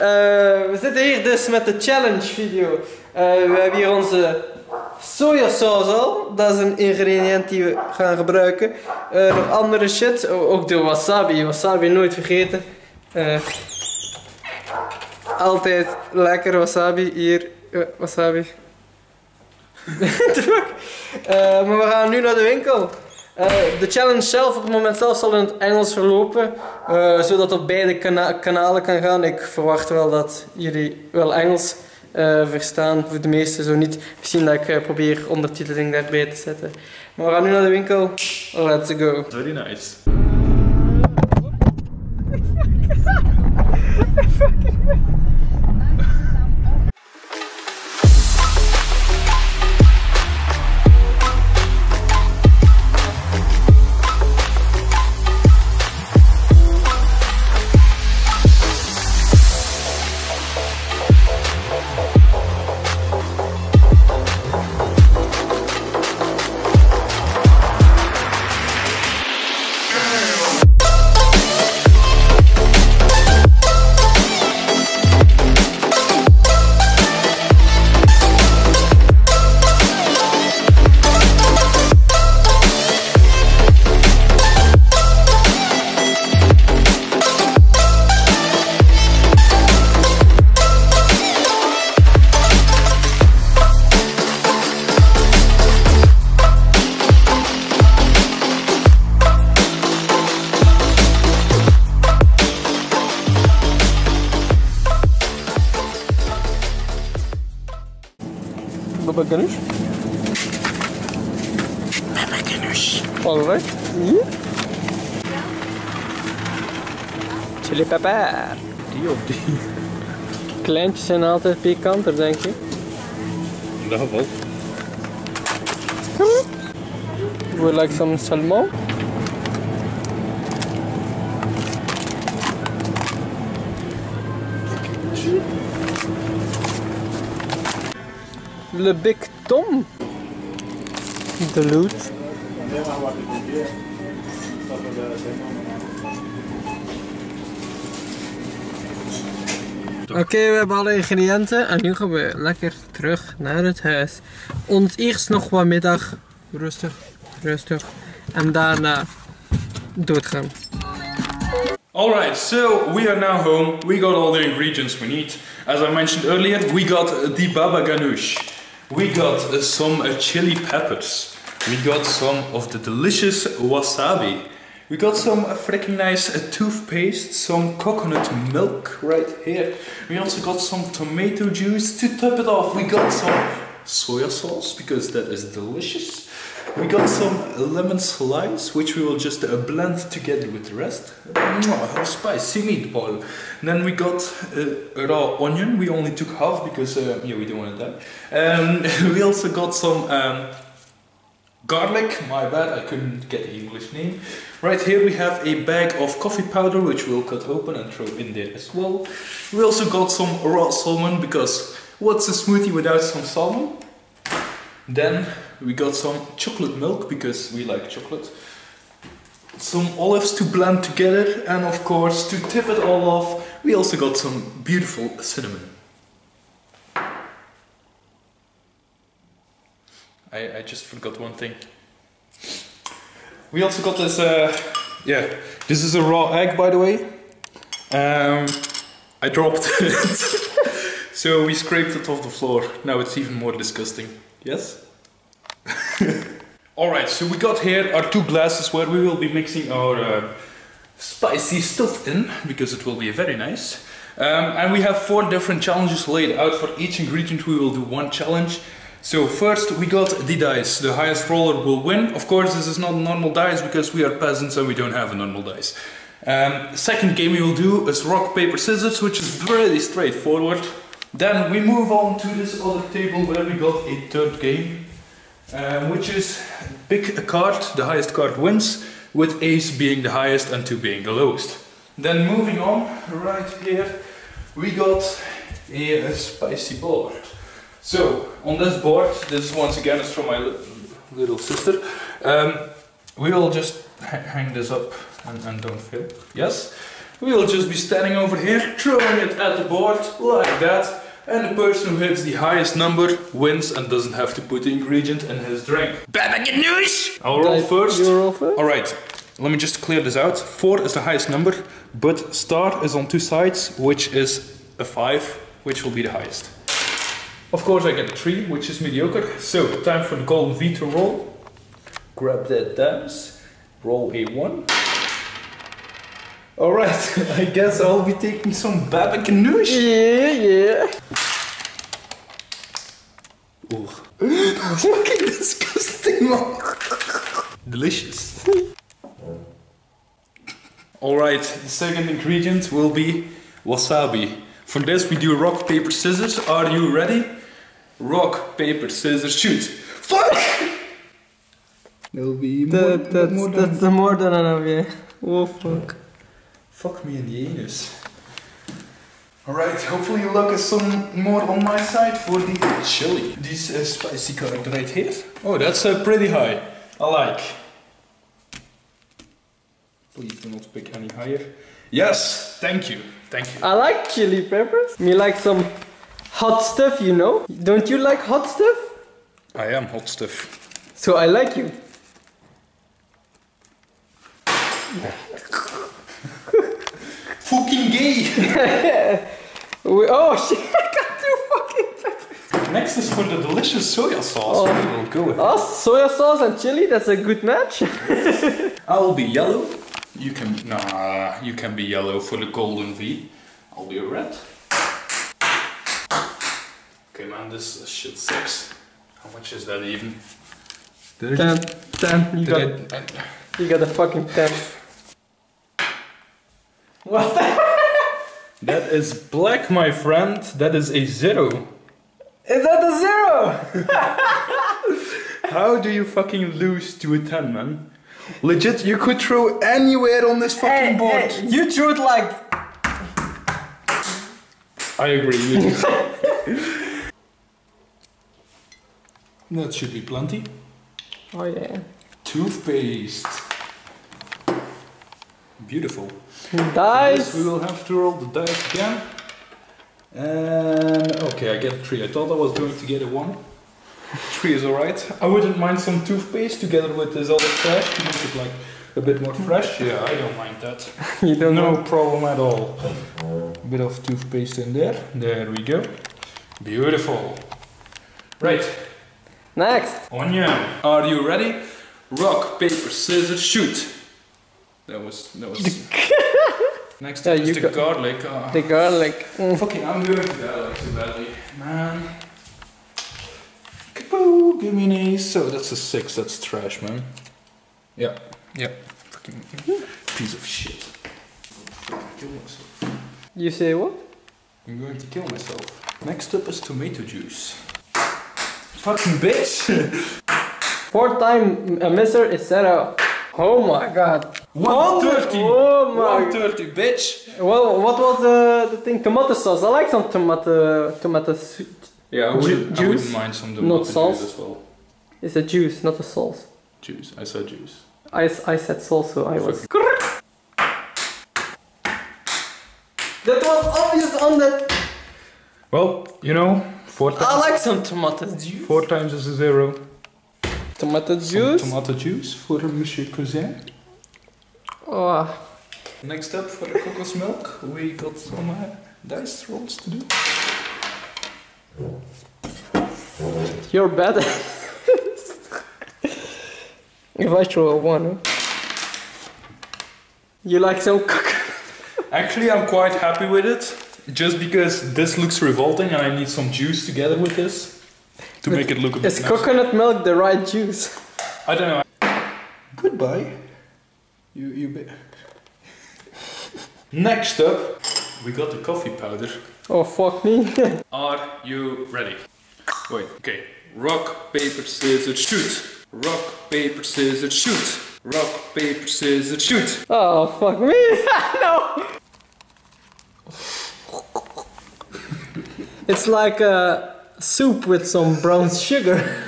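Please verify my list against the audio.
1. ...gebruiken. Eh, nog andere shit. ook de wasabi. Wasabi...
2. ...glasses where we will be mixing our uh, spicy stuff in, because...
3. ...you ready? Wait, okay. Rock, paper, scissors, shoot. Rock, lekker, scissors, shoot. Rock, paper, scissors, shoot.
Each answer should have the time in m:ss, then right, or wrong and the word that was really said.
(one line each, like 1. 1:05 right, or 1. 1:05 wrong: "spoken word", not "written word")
1. 0:08 right
2. 4:08 right
3. 9:31 wrong: "paper", not "lekker".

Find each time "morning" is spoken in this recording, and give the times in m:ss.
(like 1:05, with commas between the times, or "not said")
not said.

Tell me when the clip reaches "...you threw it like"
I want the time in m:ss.
7:11.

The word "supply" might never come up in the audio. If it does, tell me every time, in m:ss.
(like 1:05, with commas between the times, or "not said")
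not said.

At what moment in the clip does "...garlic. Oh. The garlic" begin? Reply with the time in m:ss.
7:57.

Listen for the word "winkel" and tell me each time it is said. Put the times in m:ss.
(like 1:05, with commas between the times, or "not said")
0:22, 0:37.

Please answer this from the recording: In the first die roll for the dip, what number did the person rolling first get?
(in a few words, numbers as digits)
3.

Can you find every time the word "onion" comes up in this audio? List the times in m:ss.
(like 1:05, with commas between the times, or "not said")
3:15, 7:50.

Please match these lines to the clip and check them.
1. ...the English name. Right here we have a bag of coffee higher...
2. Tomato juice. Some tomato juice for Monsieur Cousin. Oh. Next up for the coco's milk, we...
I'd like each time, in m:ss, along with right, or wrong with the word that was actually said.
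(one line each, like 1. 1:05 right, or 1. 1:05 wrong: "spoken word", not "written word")
1. 3:23 wrong: "powder", not "higher"
2. 8:50 right.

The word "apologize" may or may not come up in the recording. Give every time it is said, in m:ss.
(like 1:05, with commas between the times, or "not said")
not said.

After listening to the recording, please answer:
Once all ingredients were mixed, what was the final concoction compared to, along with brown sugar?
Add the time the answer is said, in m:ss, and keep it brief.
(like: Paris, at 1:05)
Soup, at 9:47.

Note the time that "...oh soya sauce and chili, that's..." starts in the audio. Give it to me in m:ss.
6:35.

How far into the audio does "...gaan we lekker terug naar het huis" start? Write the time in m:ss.
2:31.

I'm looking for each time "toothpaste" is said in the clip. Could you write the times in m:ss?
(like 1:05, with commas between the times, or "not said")
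2:56, 7:22, 7:36, 7:44.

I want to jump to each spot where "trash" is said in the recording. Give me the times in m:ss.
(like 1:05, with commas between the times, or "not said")
7:37, 8:06.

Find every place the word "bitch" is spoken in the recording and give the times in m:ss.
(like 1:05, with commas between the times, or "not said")
8:19, 8:26.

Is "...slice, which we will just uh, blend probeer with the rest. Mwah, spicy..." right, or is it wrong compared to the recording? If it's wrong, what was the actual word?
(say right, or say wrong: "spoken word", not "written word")
wrong: "together", not "probeer".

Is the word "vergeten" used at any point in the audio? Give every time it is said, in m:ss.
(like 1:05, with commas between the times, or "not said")
0:12.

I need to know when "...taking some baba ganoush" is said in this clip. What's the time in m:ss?
5:28.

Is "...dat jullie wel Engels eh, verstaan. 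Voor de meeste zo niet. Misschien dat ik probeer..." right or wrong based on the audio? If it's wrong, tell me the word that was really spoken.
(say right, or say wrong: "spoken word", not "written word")
right.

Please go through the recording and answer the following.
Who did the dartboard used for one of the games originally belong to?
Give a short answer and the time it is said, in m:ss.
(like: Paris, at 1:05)
Little sister, at 4:51.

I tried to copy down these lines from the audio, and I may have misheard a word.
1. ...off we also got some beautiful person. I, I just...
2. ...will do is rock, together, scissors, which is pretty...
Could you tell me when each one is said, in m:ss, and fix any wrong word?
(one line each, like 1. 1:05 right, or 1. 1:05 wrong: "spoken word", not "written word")
1. 3:43 wrong: "cinnamon", not "person"
2. 4:27 wrong: "paper", not "together".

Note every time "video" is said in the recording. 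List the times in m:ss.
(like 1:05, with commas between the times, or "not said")
0:02.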